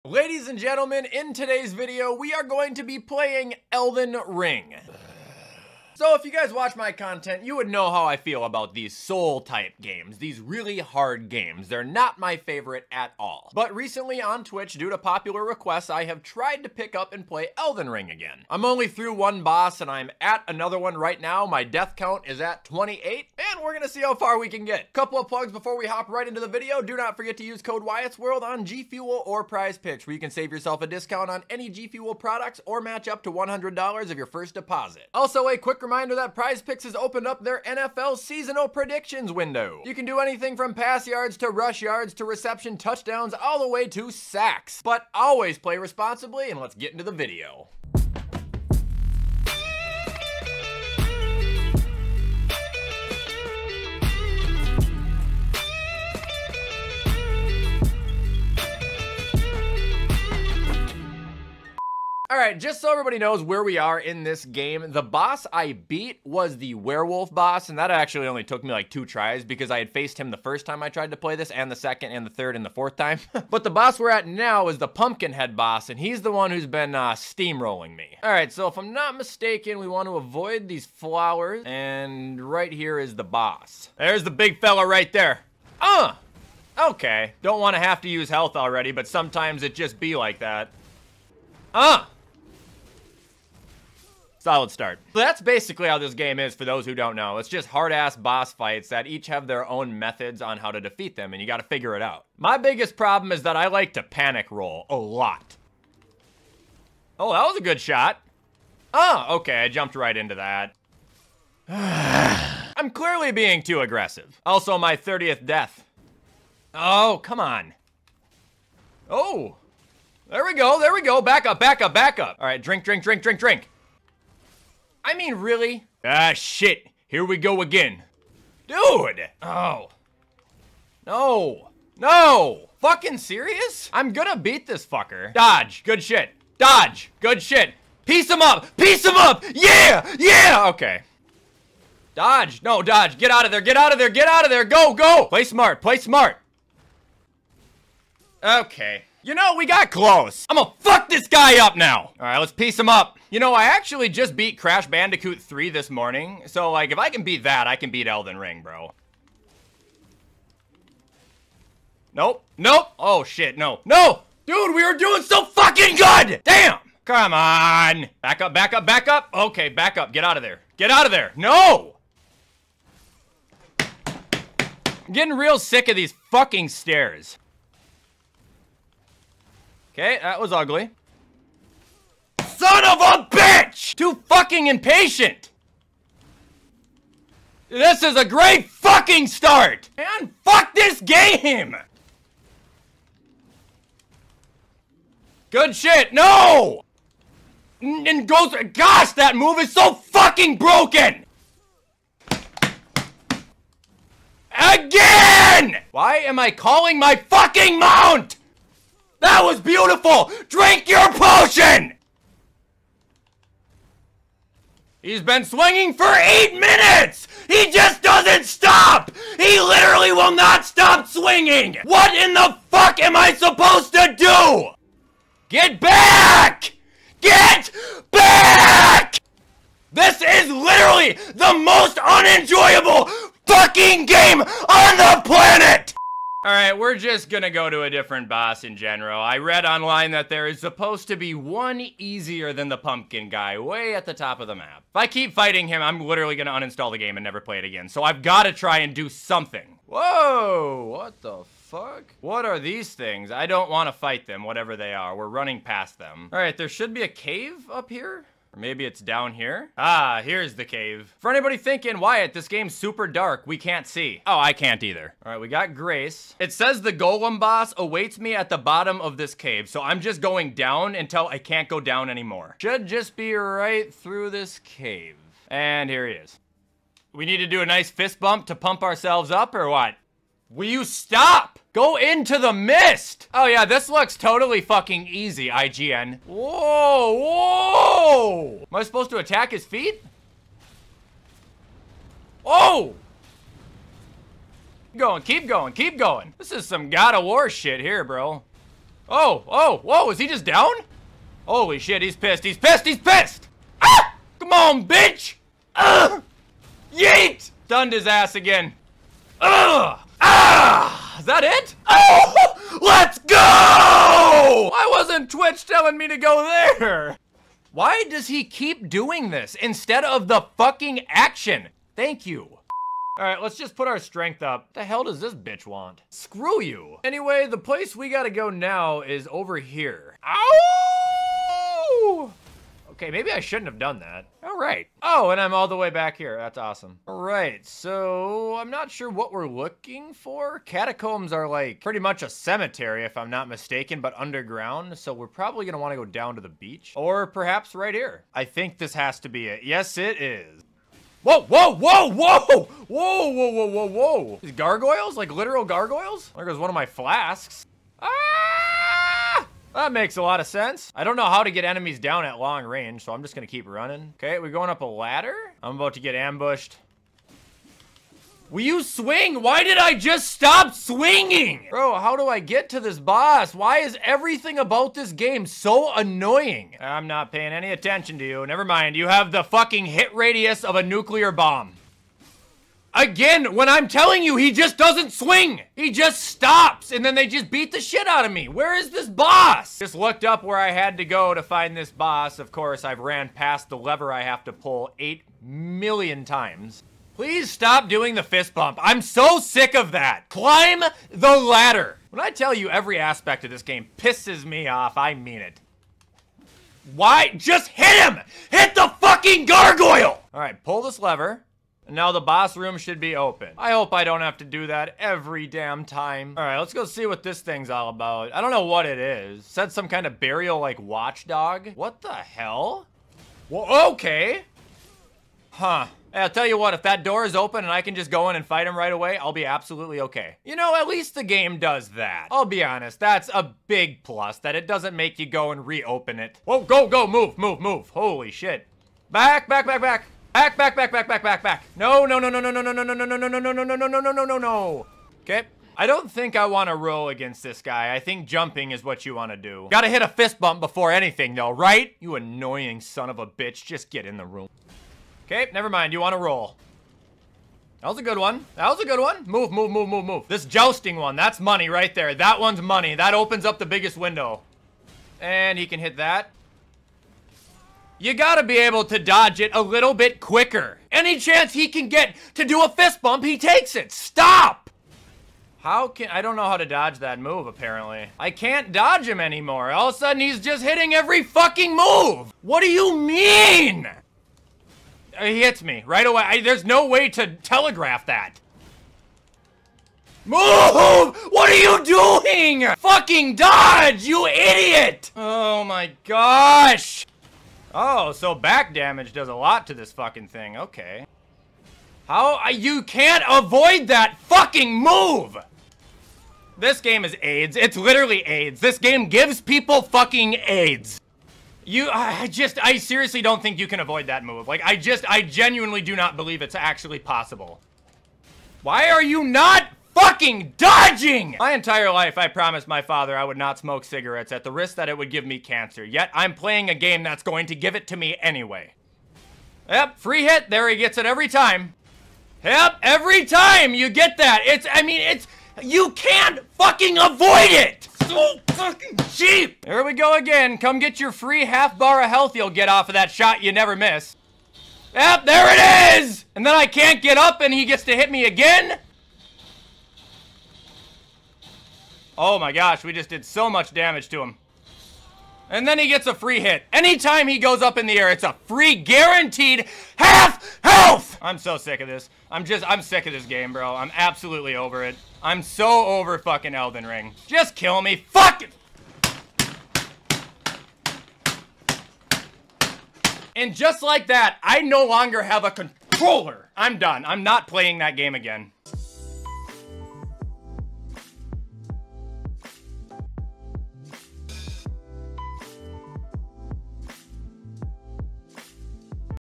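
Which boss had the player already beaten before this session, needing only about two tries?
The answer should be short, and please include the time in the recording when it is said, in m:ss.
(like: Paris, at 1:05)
the werewolf boss, at 1:06.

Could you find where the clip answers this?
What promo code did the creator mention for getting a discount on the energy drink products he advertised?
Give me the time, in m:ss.
0:27.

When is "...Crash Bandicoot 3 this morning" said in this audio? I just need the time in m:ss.
2:34.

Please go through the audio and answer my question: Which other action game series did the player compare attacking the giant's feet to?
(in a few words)
God of War.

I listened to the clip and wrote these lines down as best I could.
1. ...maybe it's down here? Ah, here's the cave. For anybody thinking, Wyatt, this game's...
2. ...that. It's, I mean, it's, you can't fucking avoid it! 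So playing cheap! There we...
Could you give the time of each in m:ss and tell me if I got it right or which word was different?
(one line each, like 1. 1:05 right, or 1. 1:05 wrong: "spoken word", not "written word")
1. 4:18 right
2. 8:54 wrong: "fucking", not "playing".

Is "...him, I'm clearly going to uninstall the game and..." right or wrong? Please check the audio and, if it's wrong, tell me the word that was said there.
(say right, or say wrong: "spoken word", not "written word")
wrong: "literally", not "clearly".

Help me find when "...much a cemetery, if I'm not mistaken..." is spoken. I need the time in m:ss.
5:41.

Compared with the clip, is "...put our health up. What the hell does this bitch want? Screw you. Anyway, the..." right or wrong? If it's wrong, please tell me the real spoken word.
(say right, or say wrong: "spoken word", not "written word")
wrong: "strength", not "health".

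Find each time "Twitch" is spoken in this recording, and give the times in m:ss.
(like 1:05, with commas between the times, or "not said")
0:14, 5:15.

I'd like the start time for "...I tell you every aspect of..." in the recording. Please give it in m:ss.
6:42.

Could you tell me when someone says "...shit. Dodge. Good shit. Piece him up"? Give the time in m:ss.
2:16.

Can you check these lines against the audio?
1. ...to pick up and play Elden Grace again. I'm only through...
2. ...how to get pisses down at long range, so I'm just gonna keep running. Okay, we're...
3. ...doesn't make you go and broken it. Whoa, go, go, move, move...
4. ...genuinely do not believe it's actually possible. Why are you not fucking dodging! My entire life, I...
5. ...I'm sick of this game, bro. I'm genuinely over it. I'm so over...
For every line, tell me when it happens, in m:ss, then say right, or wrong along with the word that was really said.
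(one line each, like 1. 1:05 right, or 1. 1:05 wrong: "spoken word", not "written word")
1. 0:16 wrong: "Ring", not "Grace"
2. 6:01 wrong: "enemies", not "pisses"
3. 7:14 wrong: "reopen", not "broken"
4. 8:35 right
5. 9:22 wrong: "absolutely", not "genuinely".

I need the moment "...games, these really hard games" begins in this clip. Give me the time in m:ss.
0:09.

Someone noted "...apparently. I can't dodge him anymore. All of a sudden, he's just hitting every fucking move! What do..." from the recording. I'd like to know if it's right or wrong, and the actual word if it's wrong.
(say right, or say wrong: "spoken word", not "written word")
right.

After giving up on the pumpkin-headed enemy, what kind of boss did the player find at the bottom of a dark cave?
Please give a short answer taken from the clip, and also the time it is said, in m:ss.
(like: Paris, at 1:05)
golem, at 4:26.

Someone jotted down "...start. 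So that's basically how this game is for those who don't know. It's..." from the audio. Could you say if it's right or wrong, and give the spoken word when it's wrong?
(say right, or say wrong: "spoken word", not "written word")
right.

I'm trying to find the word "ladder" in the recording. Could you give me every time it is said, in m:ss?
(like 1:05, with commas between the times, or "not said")
6:04, 6:41.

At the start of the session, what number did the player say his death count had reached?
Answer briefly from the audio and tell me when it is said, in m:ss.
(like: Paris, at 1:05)
28, at 0:22.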